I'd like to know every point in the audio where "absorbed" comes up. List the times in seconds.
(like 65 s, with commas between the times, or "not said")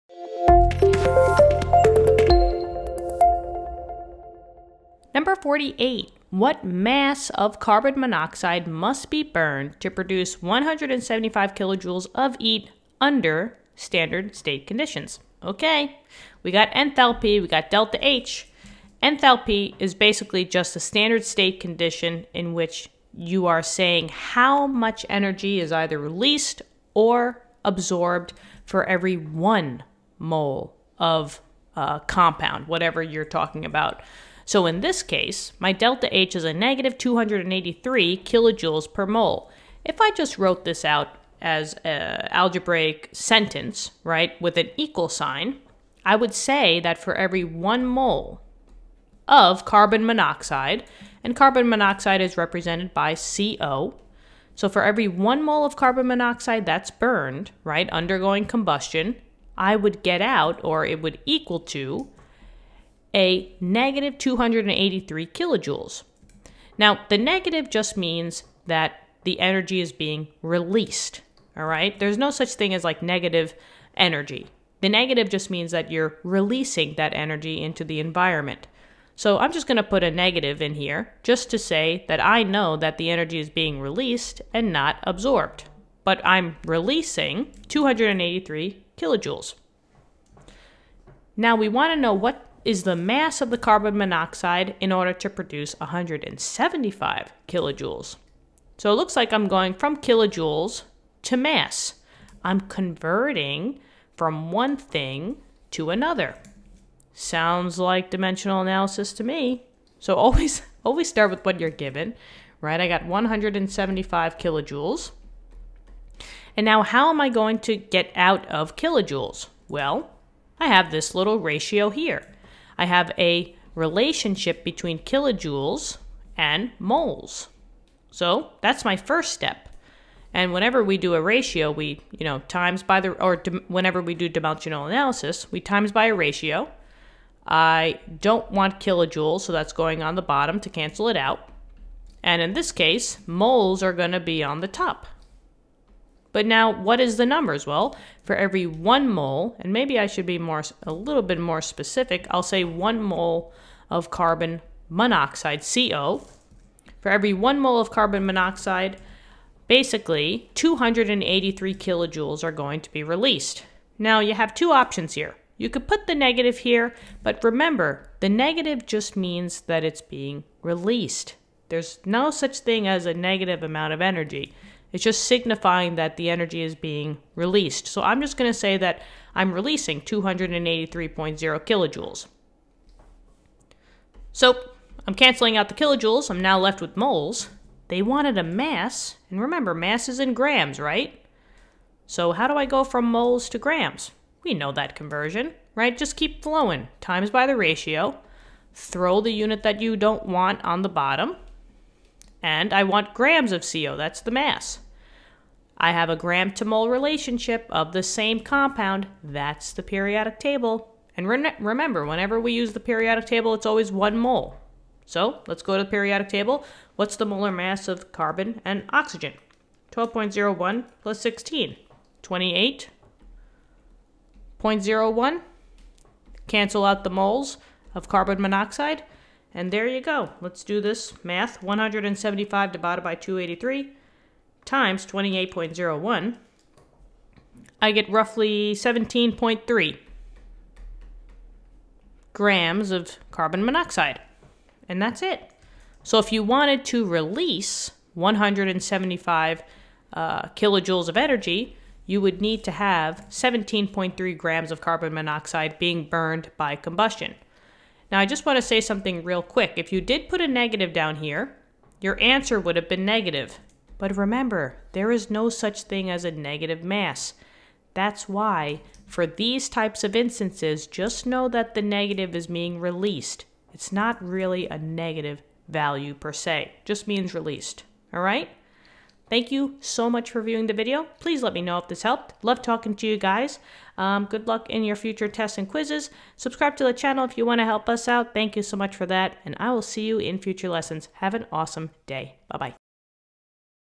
27 s, 85 s.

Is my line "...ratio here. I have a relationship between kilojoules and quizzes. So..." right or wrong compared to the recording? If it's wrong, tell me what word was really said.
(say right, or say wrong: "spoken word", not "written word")
wrong: "moles", not "quizzes".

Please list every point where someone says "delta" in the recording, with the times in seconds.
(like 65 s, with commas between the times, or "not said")
17 s, 35 s.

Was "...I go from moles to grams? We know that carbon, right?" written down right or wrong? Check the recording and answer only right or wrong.
wrong.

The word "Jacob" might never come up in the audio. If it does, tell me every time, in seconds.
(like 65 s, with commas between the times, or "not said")
not said.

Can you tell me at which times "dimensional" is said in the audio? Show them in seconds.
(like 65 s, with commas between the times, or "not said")
108 s, 134 s.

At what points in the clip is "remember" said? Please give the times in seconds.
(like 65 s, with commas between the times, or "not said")
167 s, 189 s, 211 s, 264 s.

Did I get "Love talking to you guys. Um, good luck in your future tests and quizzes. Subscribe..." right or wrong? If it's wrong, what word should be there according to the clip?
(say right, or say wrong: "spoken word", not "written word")
right.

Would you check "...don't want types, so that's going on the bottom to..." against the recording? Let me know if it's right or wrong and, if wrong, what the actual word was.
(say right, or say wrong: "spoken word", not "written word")
wrong: "kilojoules", not "types".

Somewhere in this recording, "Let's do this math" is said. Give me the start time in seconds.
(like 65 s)
230 s.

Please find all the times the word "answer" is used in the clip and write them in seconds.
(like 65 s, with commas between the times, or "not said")
262 s.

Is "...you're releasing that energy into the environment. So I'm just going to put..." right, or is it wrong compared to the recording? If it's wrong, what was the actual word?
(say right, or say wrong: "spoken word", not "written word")
right.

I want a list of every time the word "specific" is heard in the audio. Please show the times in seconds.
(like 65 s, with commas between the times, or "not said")
151 s.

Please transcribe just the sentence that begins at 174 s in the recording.
It's just signifying that the energy is being released.